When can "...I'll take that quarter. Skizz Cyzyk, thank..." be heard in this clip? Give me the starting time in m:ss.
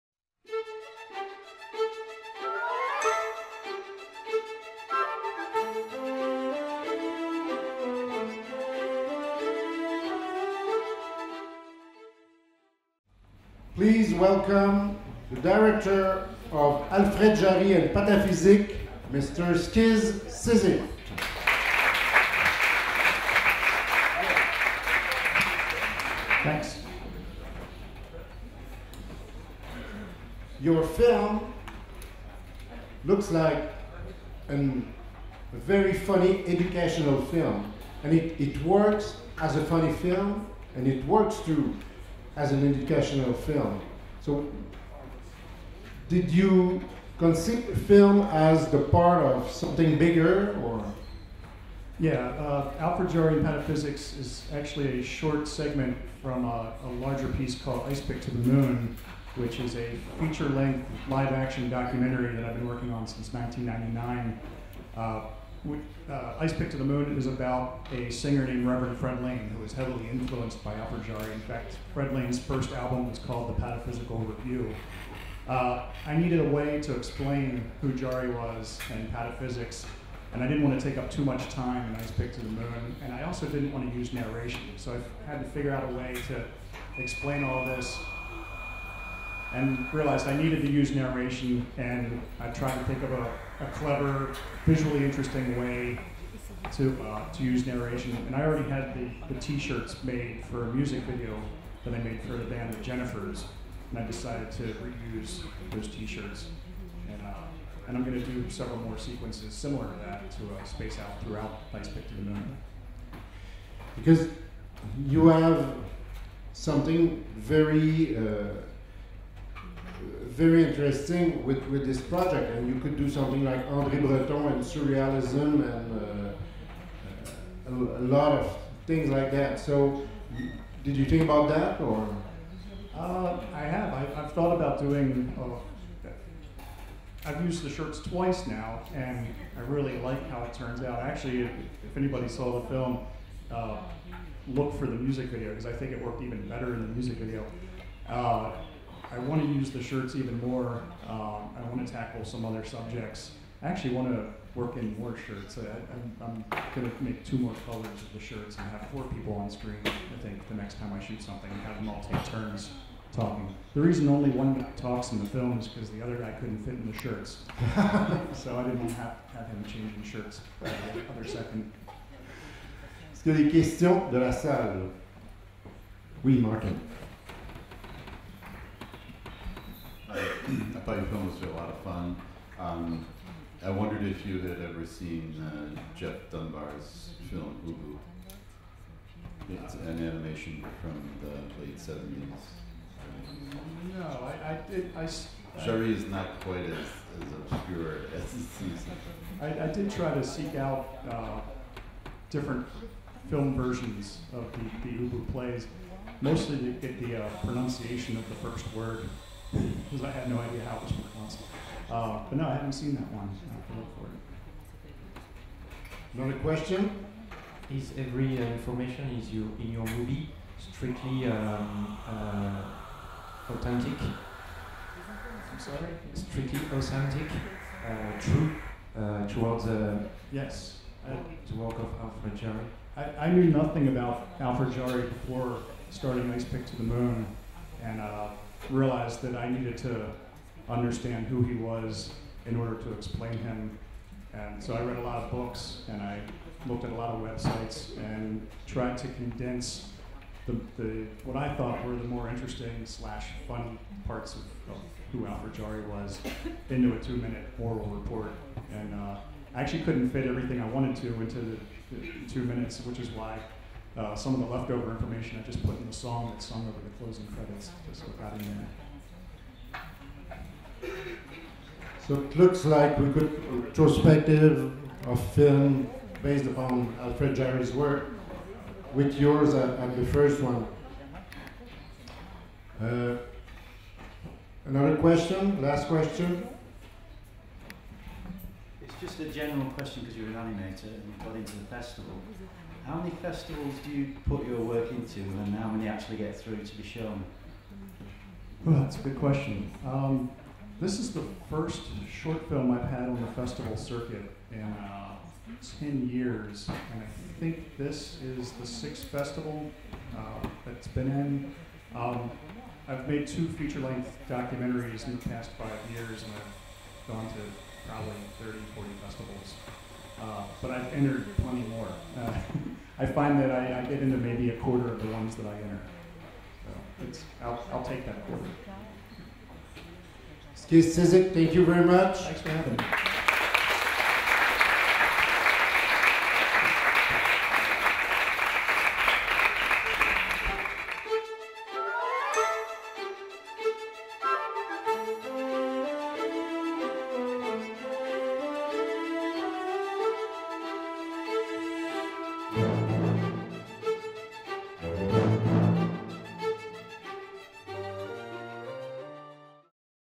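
5:27.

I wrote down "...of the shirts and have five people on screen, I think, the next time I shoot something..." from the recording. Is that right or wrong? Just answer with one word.
wrong.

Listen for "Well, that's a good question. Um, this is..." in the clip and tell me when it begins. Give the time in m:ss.
4:58.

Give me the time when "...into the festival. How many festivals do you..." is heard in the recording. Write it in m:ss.
4:51.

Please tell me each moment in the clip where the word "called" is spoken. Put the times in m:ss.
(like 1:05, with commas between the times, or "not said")
0:57, 1:13.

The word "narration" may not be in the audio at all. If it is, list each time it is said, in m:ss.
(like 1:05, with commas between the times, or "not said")
1:24, 1:30, 1:37.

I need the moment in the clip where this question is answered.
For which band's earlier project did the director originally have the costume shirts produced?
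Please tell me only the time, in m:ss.
1:42.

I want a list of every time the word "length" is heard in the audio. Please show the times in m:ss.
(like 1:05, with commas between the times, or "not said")
1:00, 5:13.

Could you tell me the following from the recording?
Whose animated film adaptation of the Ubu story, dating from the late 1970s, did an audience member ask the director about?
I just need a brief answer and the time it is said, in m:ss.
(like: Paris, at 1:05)
Geoff Dunbar, at 3:05.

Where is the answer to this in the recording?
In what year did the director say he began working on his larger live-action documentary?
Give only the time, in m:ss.
1:03.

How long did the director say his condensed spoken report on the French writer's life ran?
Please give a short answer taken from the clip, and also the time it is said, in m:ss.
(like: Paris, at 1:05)
2 minutes, at 4:16.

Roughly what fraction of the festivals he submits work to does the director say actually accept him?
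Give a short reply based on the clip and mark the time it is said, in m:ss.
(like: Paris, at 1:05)
a quarter, at 5:24.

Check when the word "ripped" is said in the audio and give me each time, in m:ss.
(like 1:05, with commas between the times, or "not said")
not said.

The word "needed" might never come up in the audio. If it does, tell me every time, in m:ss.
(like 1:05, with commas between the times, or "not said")
1:16, 1:30, 3:59.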